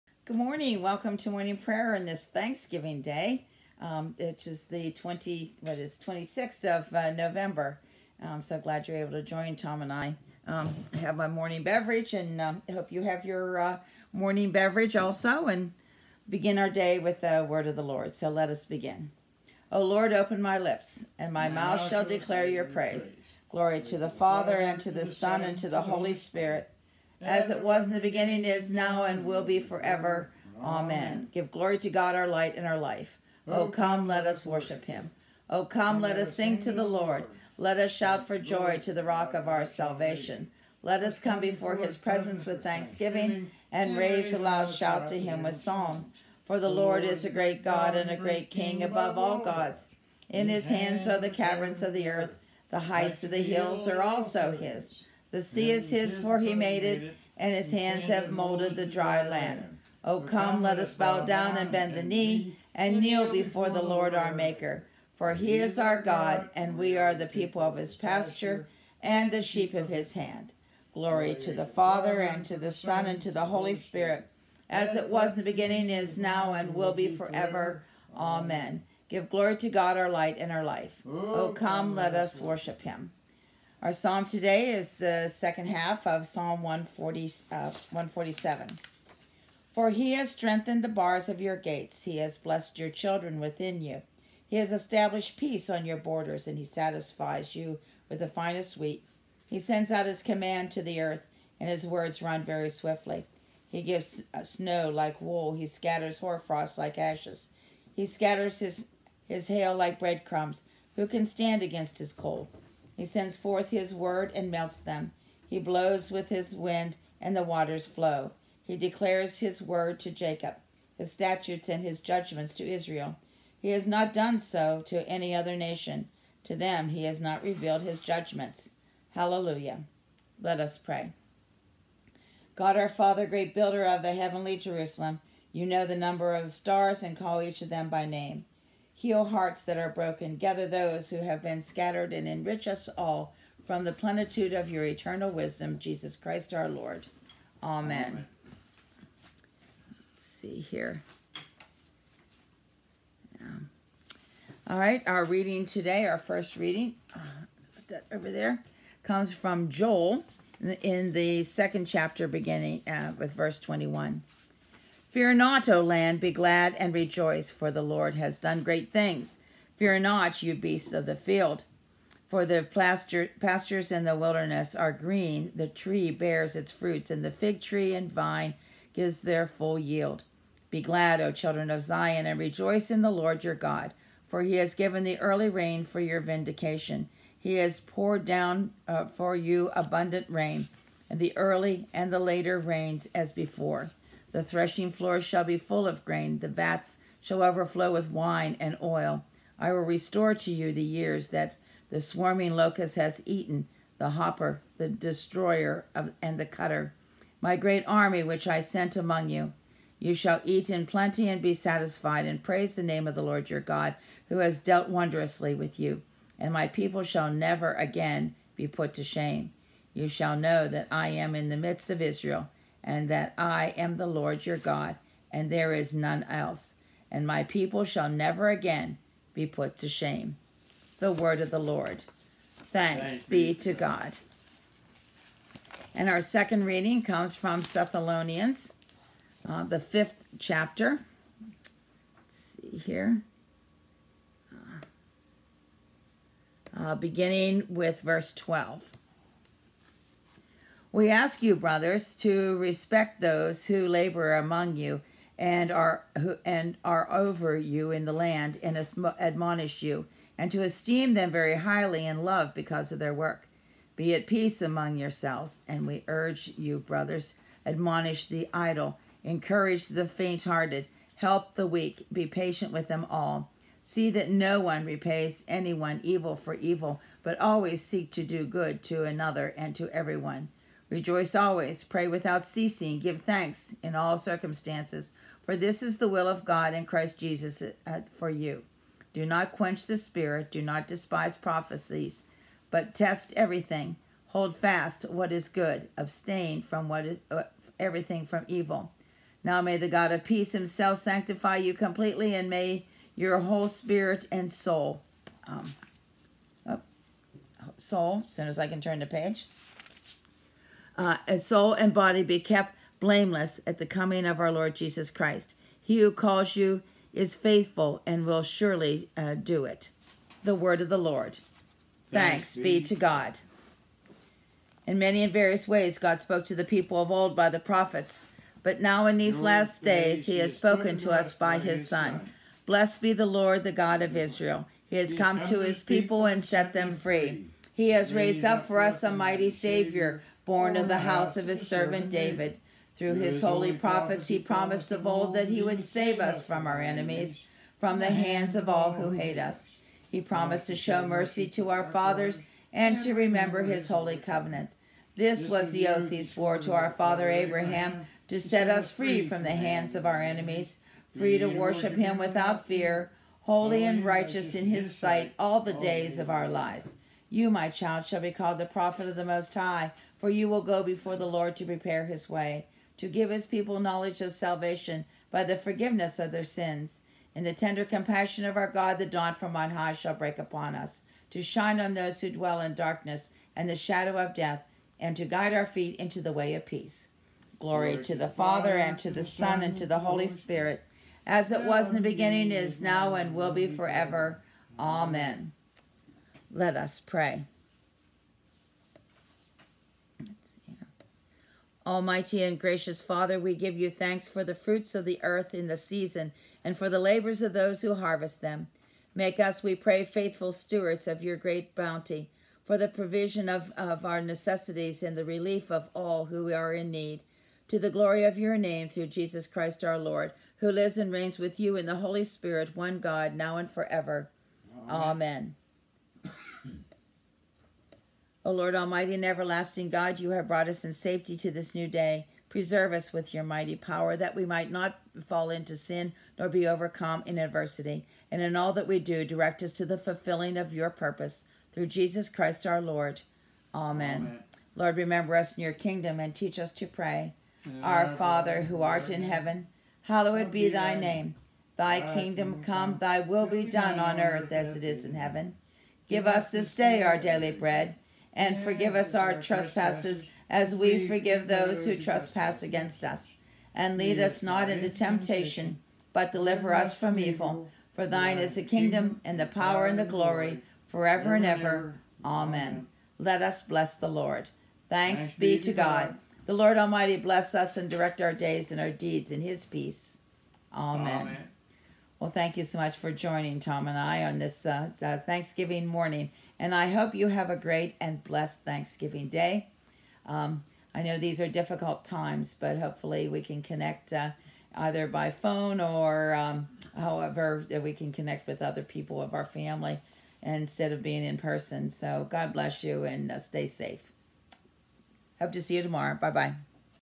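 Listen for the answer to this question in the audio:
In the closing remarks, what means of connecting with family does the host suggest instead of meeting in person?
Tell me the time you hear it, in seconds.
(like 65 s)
495 s.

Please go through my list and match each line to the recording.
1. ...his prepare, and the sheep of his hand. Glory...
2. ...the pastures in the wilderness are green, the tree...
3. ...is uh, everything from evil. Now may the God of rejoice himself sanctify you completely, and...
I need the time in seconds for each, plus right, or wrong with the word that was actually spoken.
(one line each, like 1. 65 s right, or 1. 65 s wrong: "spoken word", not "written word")
1. 67 s wrong: "pasture", not "prepare"
2. 172 s right
3. 297 s wrong: "peace", not "rejoice".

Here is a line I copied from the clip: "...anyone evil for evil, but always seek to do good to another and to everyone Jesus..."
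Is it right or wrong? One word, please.
wrong.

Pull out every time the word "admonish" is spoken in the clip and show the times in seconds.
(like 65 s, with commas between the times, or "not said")
259 s, 267 s.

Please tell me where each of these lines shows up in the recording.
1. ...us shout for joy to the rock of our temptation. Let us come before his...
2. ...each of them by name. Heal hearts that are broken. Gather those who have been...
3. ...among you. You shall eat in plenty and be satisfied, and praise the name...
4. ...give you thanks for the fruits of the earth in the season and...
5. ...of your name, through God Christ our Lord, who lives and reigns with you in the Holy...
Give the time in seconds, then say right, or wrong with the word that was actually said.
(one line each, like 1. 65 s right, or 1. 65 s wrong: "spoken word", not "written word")
1. 37 s wrong: "salvation", not "temptation"
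2. 137 s right
3. 208 s right
4. 403 s right
5. 418 s wrong: "Jesus", not "God".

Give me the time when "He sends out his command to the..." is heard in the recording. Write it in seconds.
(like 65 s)
99 s.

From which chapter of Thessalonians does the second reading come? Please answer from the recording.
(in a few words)
Fifth chapter.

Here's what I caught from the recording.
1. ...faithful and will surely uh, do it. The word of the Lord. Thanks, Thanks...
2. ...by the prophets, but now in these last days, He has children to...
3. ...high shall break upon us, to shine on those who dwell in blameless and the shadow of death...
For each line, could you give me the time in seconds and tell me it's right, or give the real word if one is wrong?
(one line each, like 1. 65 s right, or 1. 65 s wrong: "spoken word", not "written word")
1. 317 s right
2. 327 s wrong: "spoken", not "children"
3. 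379 s wrong: "darkness", not "blameless".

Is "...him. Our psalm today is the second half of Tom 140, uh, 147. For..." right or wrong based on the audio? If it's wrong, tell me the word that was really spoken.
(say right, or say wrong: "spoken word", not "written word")
wrong: "Psalm", not "Tom".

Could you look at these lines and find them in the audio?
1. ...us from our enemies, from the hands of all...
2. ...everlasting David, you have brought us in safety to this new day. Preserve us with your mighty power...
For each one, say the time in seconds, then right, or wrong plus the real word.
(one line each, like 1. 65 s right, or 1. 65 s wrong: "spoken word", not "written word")
1. 346 s right
2. 429 s wrong: "God", not "David".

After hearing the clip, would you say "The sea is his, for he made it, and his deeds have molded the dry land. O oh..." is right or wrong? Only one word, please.
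wrong.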